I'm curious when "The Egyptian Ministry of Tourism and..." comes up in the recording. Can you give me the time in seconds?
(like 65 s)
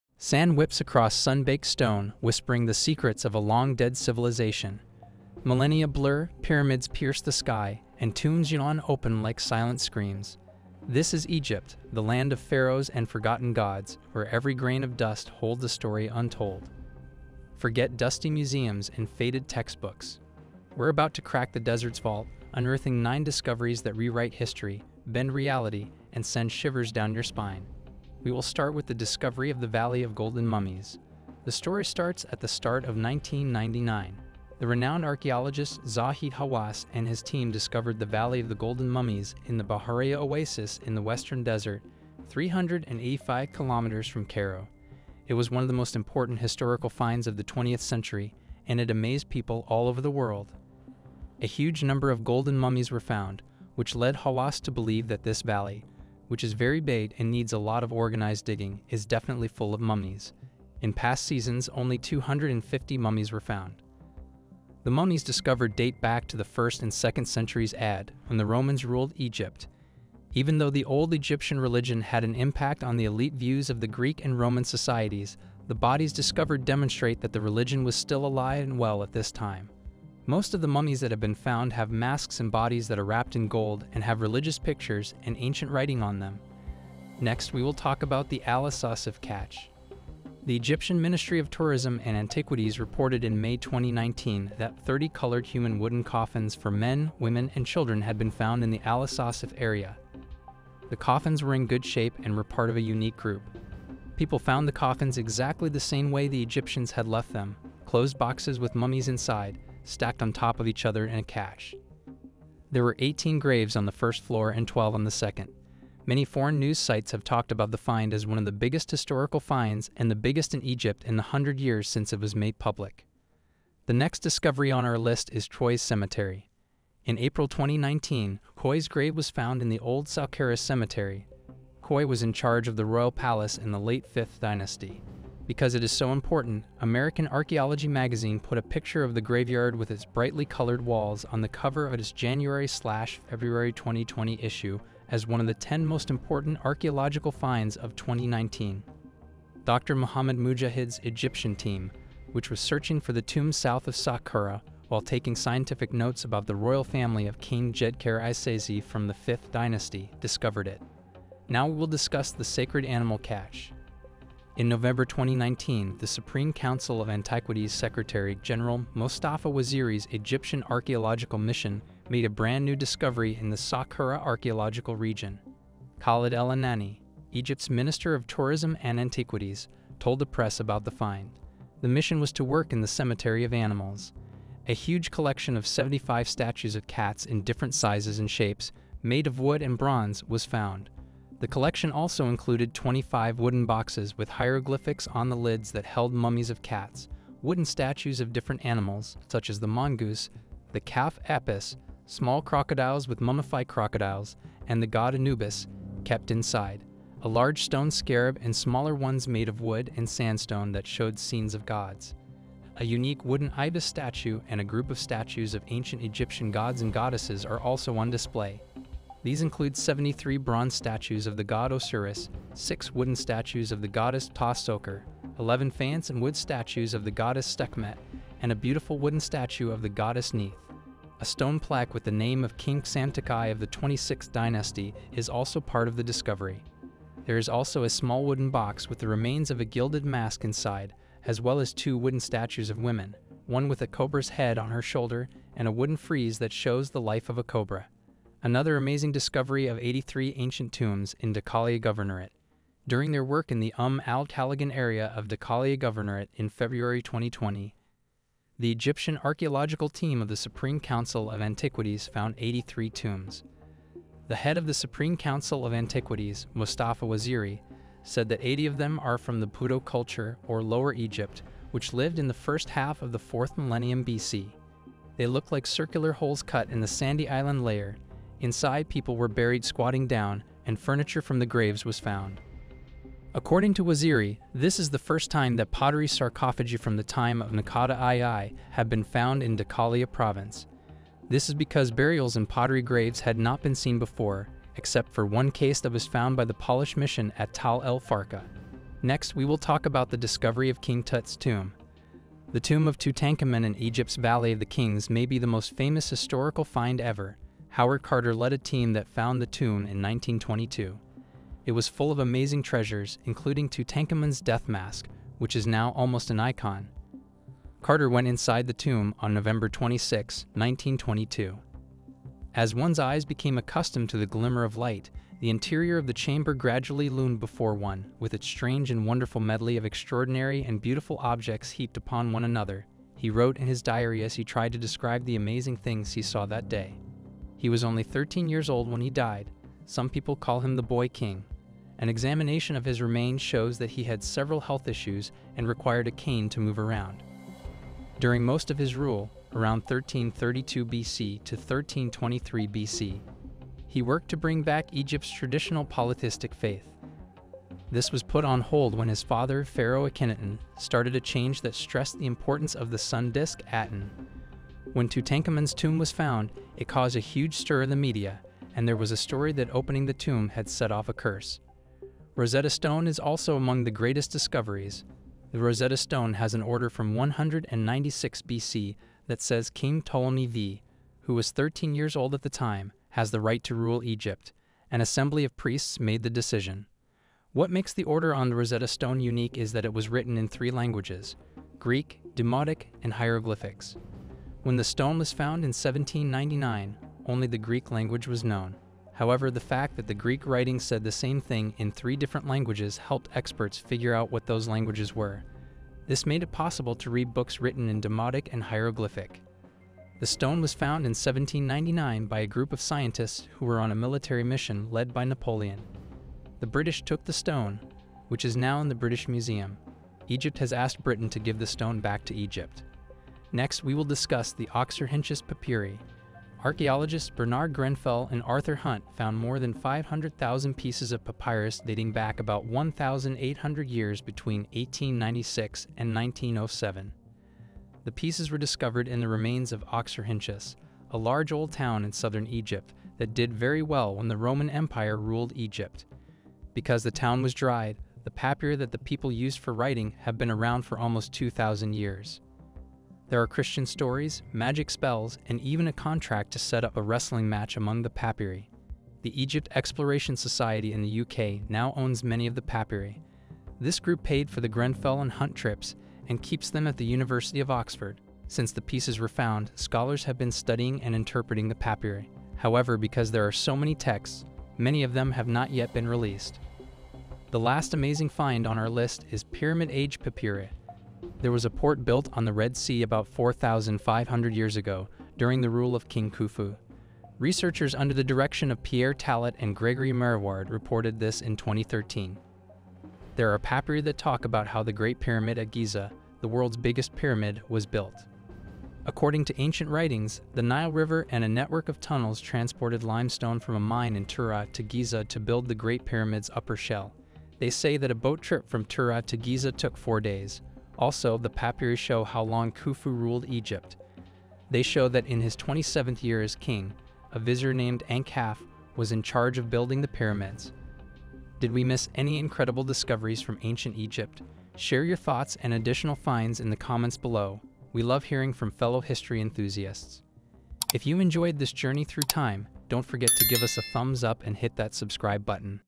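90 s.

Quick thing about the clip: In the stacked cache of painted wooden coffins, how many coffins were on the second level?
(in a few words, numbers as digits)
12.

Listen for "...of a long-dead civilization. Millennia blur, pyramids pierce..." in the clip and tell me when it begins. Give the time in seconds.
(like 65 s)
3 s.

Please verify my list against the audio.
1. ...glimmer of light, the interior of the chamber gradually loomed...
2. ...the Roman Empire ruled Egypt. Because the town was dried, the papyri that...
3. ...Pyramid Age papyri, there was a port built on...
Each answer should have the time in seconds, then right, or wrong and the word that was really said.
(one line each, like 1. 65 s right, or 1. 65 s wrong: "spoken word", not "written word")
1. 324 s right
2. 444 s right
3. 479 s right.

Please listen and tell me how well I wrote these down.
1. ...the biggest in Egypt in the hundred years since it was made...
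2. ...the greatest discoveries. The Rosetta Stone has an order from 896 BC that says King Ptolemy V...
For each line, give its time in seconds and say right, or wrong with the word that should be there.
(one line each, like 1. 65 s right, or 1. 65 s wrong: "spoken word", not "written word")
1. 120 s right
2. 373 s wrong: "196", not "896".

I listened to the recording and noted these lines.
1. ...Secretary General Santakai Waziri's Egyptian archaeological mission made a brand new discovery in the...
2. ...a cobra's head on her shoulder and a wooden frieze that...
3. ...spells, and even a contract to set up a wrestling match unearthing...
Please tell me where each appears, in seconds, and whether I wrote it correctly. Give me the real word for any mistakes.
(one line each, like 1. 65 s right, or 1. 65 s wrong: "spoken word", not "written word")
1. 167 s wrong: "Mostafa", not "Santakai"
2. 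243 s right
3. 454 s wrong: "among", not "unearthing".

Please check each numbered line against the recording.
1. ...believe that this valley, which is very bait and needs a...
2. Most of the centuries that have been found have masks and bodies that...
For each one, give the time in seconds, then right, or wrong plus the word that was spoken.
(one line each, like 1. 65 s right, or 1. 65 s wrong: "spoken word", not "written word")
1. 54 s right
2. 80 s wrong: "mummies", not "centuries".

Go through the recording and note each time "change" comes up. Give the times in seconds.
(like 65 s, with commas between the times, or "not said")
361 s.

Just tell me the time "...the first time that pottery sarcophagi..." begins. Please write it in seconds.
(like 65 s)
284 s.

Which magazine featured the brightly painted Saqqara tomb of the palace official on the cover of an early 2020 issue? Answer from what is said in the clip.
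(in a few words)
American Archaeology.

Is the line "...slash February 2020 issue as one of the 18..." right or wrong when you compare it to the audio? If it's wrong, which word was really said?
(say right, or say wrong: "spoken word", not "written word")
wrong: "10", not "18".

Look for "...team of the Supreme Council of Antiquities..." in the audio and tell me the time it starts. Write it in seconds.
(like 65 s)
259 s.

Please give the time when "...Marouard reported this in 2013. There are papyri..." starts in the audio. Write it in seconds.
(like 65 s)
490 s.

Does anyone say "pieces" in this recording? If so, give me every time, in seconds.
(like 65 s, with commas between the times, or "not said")
430 s, 438 s, 468 s.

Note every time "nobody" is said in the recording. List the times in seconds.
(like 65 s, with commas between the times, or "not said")
not said.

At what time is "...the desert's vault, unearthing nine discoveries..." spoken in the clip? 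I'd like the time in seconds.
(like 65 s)
21 s.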